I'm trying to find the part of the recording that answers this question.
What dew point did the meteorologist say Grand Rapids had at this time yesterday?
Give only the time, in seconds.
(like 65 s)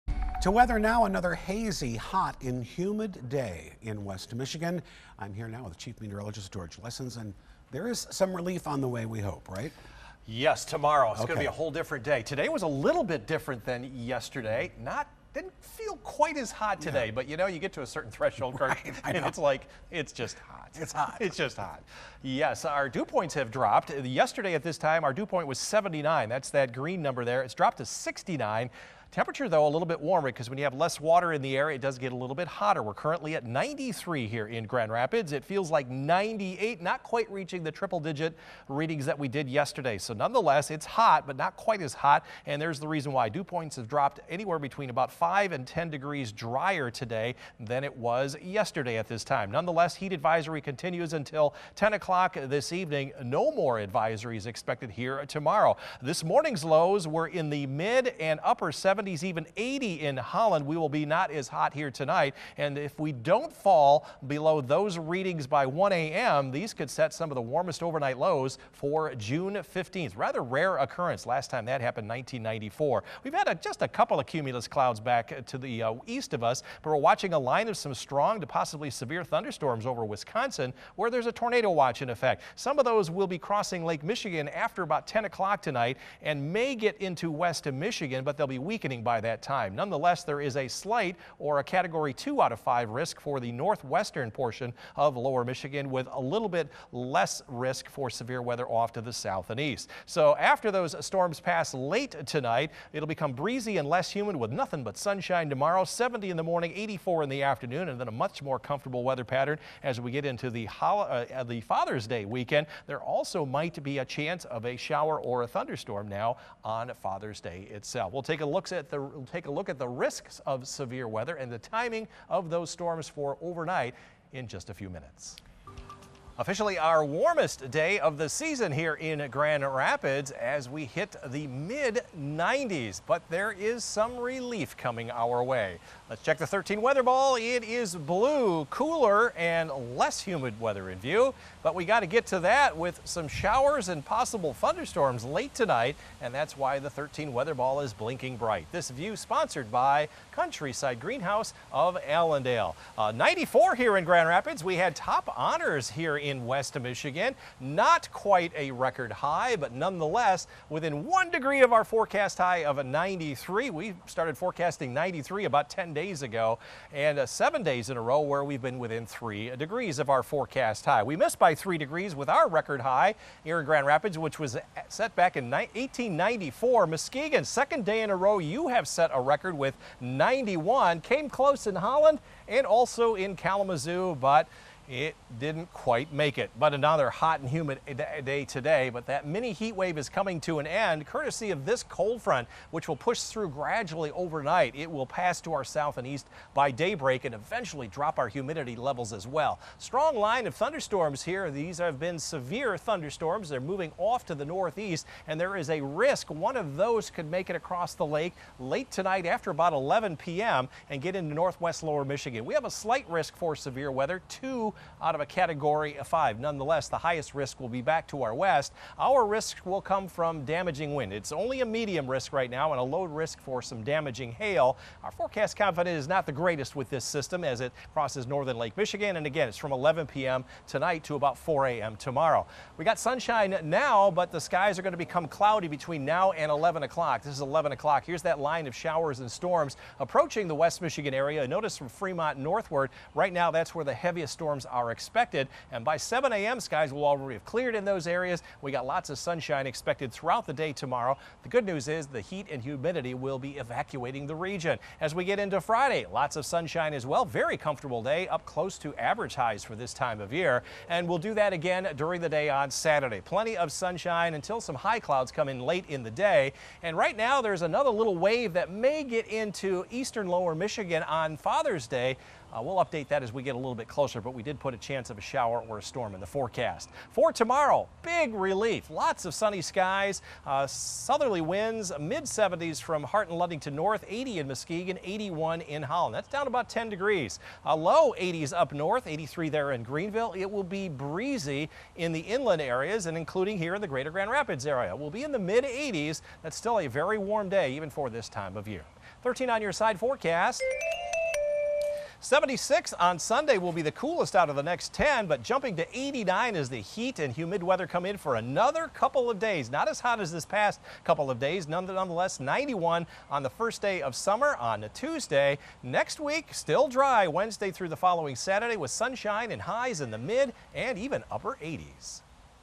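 25 s.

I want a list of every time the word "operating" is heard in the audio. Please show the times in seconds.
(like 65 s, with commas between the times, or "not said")
not said.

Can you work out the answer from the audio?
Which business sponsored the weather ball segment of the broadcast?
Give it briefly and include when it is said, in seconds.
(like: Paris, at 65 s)
Countryside Greenhouse of Allendale, at 150 s.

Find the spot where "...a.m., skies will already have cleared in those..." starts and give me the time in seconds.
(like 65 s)
246 s.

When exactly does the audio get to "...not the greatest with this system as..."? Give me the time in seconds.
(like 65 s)
226 s.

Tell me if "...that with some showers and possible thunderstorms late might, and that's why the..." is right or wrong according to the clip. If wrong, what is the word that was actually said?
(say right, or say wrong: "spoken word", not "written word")
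wrong: "tonight", not "might".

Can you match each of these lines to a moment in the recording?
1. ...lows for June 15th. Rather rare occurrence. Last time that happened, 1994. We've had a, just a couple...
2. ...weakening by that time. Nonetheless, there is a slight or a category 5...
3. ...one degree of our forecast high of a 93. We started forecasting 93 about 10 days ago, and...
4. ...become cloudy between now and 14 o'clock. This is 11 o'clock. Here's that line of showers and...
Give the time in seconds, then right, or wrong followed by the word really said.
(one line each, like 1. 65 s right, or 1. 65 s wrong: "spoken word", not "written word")
1. 68 s right
2. 88 s wrong: "2", not "5"
3. 161 s right
4. 234 s wrong: "11", not "14".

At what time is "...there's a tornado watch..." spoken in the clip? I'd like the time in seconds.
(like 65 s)
81 s.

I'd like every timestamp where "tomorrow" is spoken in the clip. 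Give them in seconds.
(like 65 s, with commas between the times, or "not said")
10 s, 55 s, 105 s, 231 s, 250 s, 277 s.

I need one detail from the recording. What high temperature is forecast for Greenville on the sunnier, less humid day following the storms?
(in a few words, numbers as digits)
83.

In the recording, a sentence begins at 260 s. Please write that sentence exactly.
And we'll do that again during the day on Saturday.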